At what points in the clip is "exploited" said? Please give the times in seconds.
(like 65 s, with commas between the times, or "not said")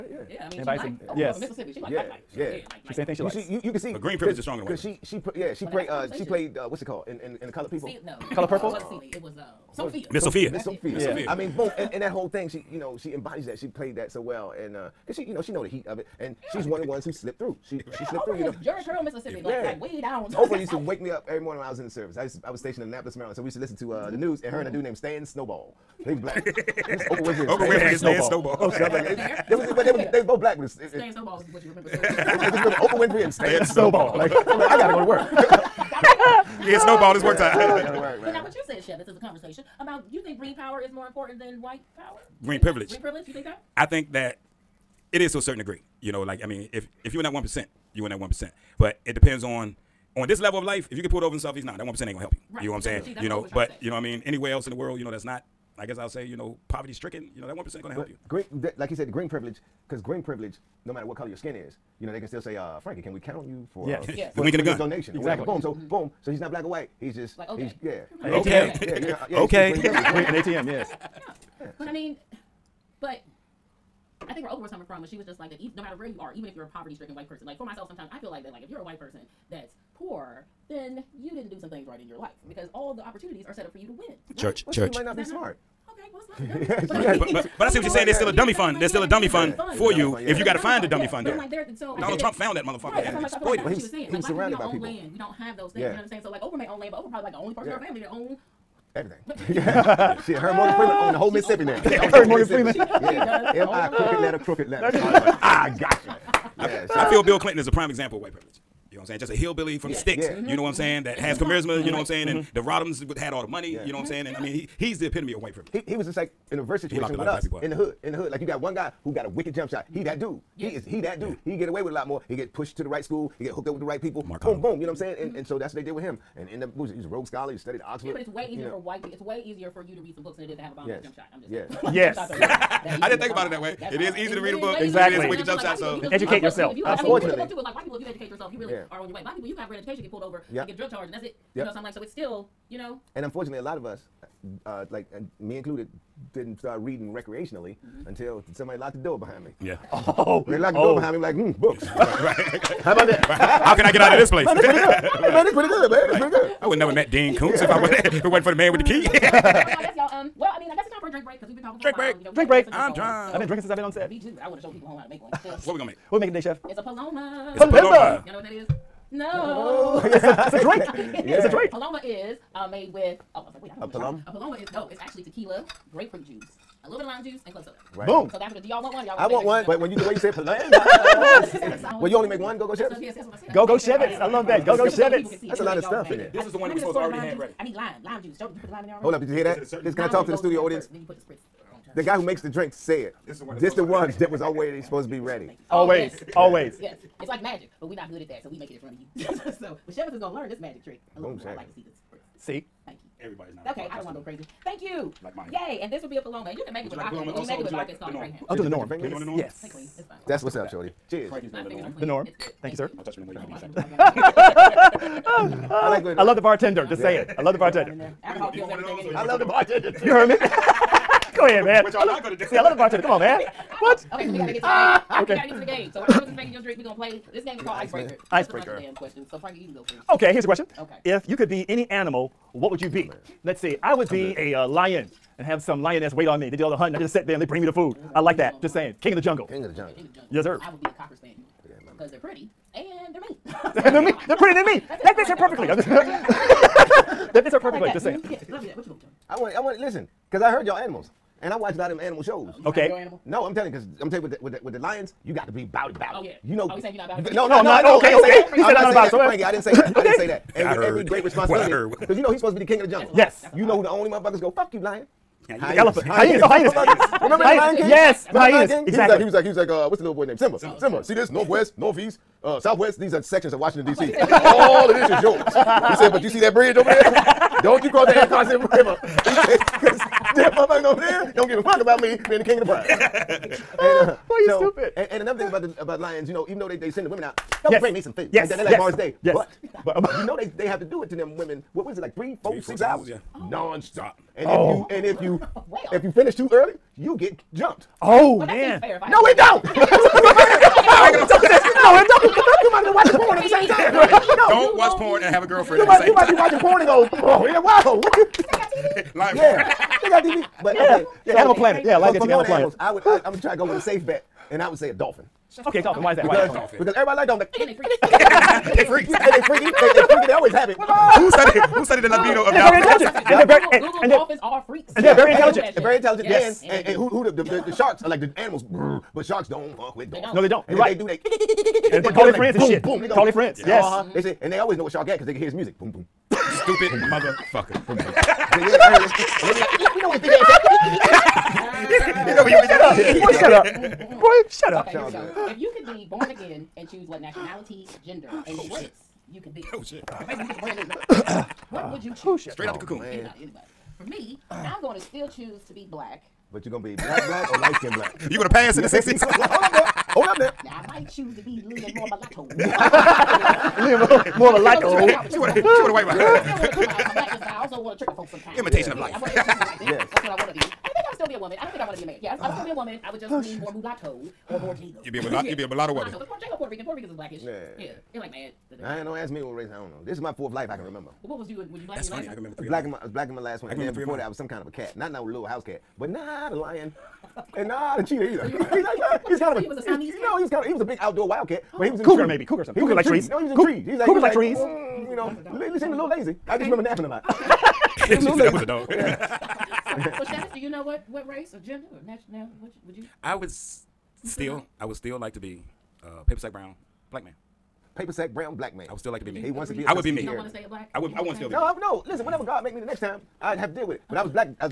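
93 s.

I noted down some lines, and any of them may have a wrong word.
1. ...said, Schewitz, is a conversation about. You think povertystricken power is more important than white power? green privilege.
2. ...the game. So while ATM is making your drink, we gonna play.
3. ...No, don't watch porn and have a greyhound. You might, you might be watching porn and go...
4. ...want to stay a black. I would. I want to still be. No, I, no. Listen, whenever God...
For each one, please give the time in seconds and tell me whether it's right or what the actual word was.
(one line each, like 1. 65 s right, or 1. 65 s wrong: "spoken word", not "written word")
1. 38 s wrong: "green", not "povertystricken"
2. 225 s wrong: "Travis", not "ATM"
3. 304 s wrong: "girlfriend", not "greyhound"
4. 410 s right.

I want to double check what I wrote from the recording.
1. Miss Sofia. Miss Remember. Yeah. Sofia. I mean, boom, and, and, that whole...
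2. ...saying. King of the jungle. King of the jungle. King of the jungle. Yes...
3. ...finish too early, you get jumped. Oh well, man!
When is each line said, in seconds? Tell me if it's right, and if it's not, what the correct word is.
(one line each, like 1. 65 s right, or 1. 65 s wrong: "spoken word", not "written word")
1. 10 s wrong: "Sofia", not "Remember"
2. 238 s right
3. 296 s right.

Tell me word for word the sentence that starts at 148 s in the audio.
until somebody locked the door behind me.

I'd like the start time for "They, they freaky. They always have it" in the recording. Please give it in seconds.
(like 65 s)
319 s.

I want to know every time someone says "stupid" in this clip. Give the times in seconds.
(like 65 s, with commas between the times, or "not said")
284 s, 336 s.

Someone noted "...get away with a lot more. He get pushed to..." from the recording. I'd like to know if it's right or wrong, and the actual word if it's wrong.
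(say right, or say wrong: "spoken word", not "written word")
right.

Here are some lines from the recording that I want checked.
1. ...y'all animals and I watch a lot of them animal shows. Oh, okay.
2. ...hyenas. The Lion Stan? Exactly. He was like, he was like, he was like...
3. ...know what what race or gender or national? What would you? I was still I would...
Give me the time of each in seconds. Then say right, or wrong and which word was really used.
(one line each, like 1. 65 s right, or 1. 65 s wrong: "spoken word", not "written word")
1. 250 s right
2. 268 s wrong: "King", not "Stan"
3. 400 s right.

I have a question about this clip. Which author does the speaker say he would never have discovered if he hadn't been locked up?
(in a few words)
Dean Koontz.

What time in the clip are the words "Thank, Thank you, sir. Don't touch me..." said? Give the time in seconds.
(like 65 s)
212 s.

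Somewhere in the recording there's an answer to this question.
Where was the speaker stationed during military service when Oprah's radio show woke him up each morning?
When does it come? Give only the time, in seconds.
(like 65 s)
22 s.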